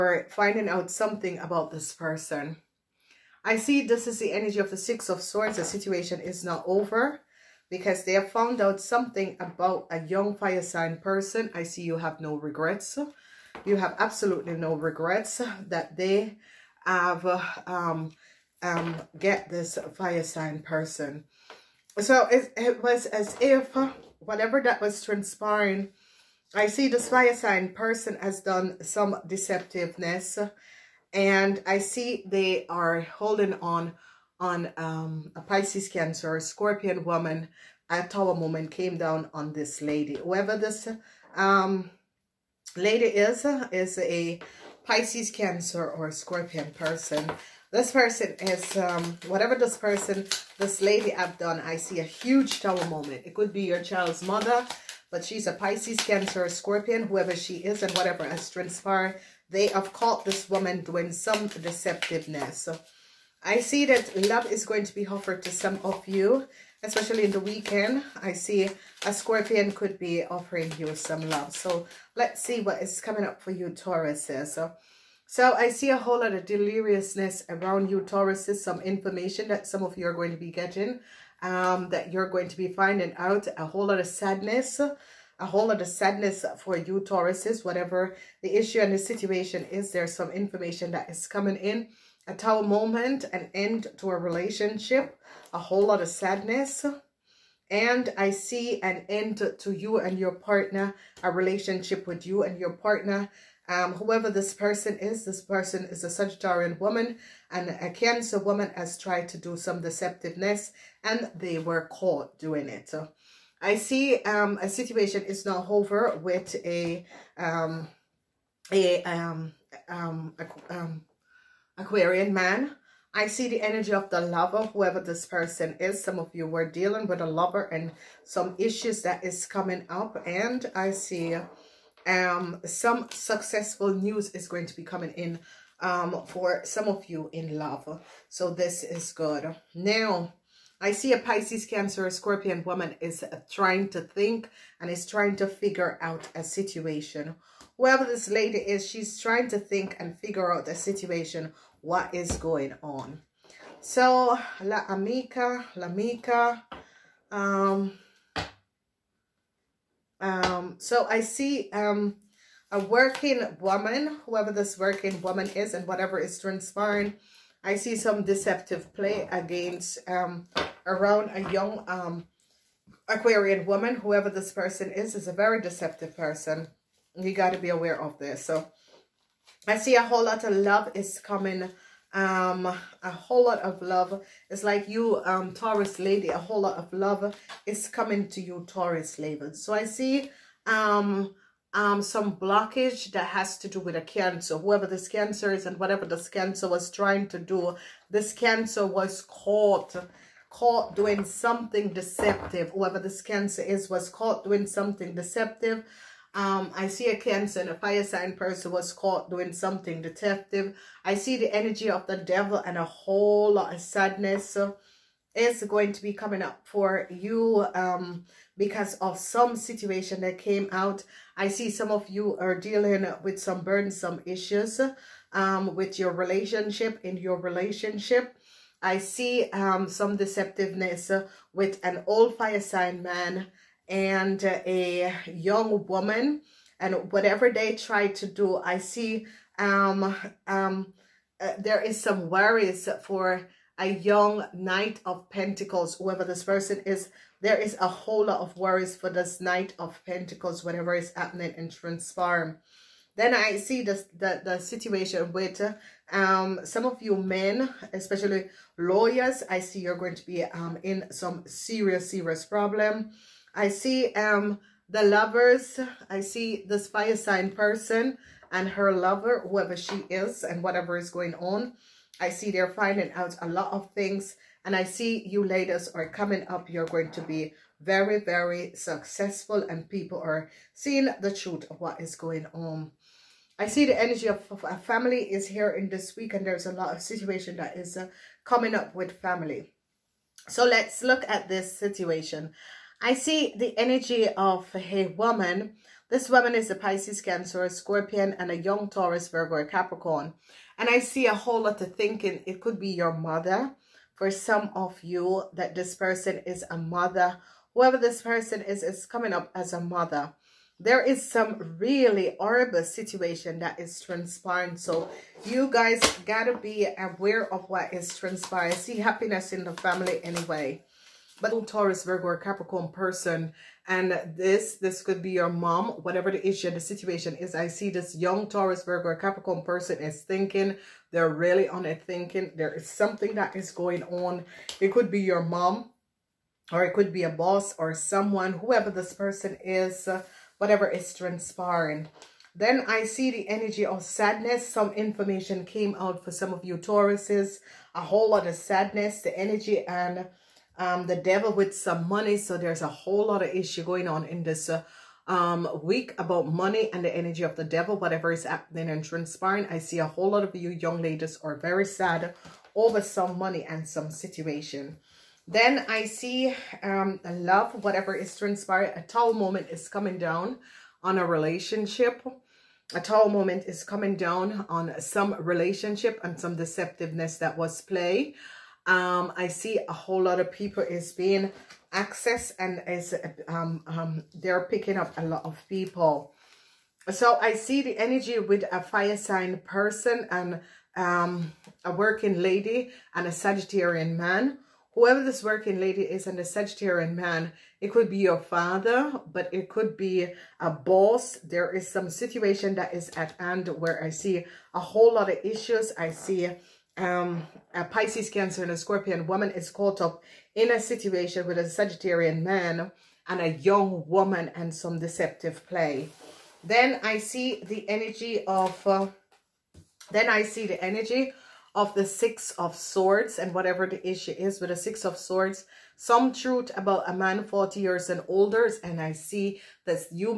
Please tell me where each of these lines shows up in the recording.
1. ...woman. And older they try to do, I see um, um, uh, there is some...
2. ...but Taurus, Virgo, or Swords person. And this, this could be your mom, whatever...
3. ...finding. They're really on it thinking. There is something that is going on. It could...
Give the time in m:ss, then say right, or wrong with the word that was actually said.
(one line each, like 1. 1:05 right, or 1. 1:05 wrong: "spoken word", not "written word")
1. 3:55 wrong: "whatever", not "older"
2. 5:21 wrong: "Capricorn", not "Swords"
3. 5:30 wrong: "thinking", not "finding".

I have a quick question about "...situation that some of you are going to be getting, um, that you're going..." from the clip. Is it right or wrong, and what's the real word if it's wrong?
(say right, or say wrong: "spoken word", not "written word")
wrong: "information", not "situation".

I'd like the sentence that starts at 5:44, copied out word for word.
Some information came out for some of you Tauruses.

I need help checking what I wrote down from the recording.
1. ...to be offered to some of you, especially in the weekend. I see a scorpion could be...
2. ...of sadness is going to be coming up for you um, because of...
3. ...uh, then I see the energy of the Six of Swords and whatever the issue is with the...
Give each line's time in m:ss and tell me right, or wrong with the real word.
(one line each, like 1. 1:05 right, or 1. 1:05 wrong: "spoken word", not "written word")
1. 1:04 right
2. 3:33 right
3. 6:58 right.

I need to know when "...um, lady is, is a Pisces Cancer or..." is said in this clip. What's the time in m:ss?
0:41.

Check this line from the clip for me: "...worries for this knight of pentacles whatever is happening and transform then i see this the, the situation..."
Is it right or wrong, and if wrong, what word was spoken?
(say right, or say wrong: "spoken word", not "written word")
right.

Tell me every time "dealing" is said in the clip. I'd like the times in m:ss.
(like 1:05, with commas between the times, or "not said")
2:06, 3:42.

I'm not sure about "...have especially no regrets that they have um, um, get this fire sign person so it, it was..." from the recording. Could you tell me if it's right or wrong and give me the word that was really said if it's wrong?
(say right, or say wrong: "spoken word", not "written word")
wrong: "absolutely", not "especially".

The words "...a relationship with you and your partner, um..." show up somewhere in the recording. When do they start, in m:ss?
1:41.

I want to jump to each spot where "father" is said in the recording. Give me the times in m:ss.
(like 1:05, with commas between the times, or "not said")
6:38.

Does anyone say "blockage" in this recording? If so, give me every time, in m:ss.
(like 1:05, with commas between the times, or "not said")
3:12.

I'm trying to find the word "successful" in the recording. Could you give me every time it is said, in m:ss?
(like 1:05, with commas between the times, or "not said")
2:13, 4:38.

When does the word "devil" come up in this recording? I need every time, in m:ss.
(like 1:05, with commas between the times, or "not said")
3:32, 5:51, 5:57.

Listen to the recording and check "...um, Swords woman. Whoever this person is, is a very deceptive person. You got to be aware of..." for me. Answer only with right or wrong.
wrong.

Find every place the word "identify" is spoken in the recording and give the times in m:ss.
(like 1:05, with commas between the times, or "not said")
not said.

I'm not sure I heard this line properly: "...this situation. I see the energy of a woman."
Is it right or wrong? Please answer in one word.
right.